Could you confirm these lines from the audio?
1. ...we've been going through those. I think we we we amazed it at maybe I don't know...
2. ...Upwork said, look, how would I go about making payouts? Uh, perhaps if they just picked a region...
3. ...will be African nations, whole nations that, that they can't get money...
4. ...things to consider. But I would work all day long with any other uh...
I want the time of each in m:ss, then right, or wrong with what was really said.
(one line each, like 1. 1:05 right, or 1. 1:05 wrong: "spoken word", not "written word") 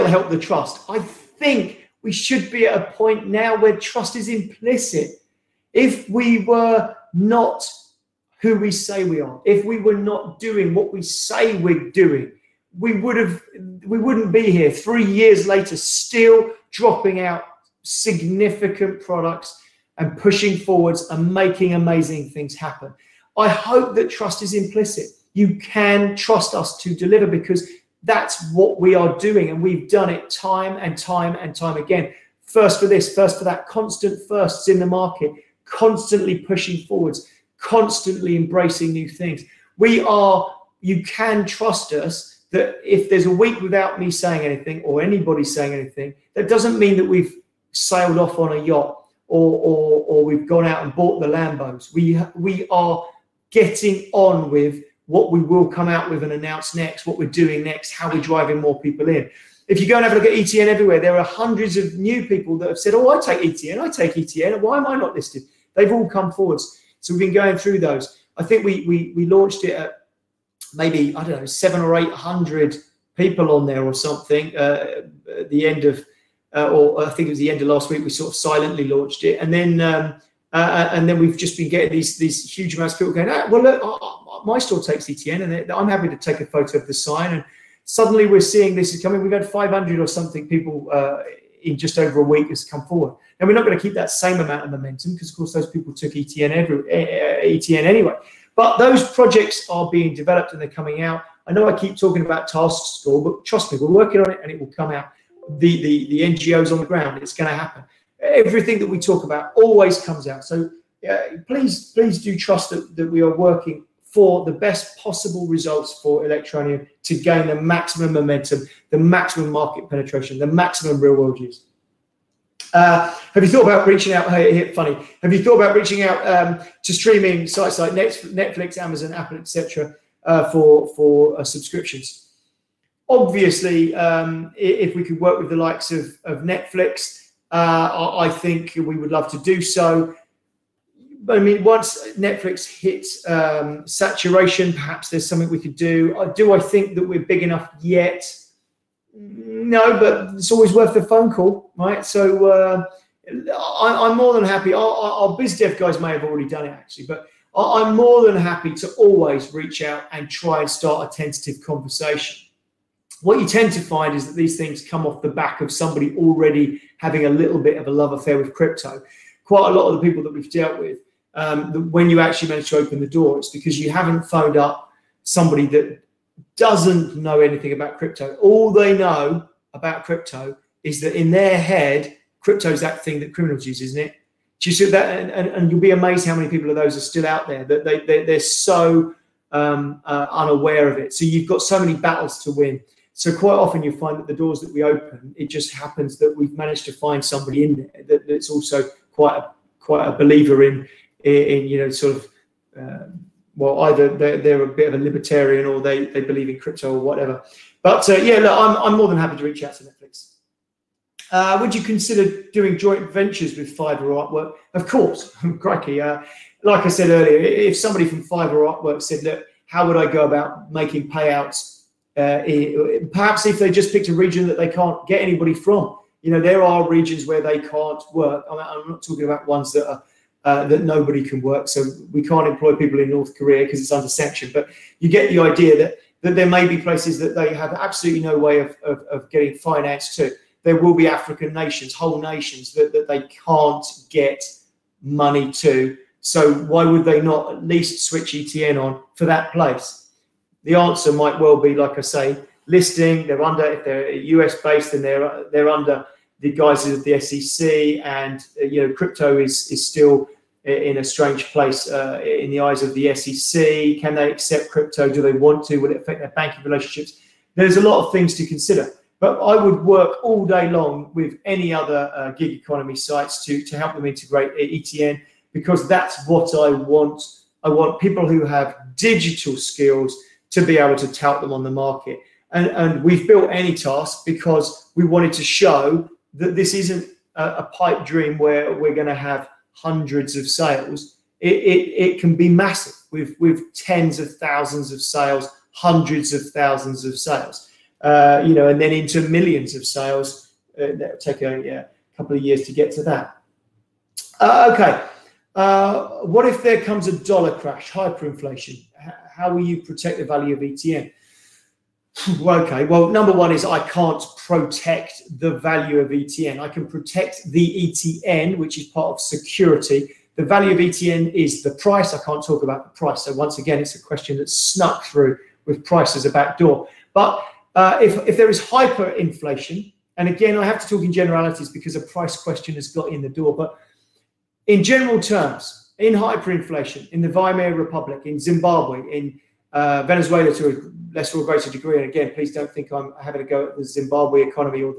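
1. 1:07 wrong: "launched", not "amazed"
2. 3:38 right
3. 4:00 right
4. 4:28 right.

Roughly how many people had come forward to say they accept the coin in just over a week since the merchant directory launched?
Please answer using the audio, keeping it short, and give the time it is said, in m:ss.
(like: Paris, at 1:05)
500, at 1:29.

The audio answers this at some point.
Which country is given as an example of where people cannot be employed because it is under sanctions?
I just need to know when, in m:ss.
3:53.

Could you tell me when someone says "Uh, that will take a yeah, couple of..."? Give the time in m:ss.
5:00.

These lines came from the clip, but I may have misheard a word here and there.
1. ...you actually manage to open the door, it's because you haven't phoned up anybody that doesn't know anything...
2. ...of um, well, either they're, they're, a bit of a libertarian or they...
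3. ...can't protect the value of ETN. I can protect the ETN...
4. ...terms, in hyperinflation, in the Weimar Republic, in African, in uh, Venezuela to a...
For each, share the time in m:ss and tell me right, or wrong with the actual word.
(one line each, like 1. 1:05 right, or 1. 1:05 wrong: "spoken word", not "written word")
1. 2:52 wrong: "somebody", not "anybody"
2. 3:22 right
3. 5:13 right
4. 5:35 wrong: "Zimbabwe", not "African".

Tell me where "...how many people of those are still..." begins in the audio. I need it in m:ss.
3:06.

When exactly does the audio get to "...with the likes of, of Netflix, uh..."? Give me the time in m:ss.
2:15.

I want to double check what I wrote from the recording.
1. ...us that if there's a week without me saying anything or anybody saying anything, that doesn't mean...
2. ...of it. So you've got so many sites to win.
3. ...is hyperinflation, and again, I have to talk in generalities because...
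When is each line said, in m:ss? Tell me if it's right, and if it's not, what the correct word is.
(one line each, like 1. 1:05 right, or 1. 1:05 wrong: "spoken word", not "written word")
1. 0:41 right
2. 3:10 wrong: "battles", not "sites"
3. 5:28 right.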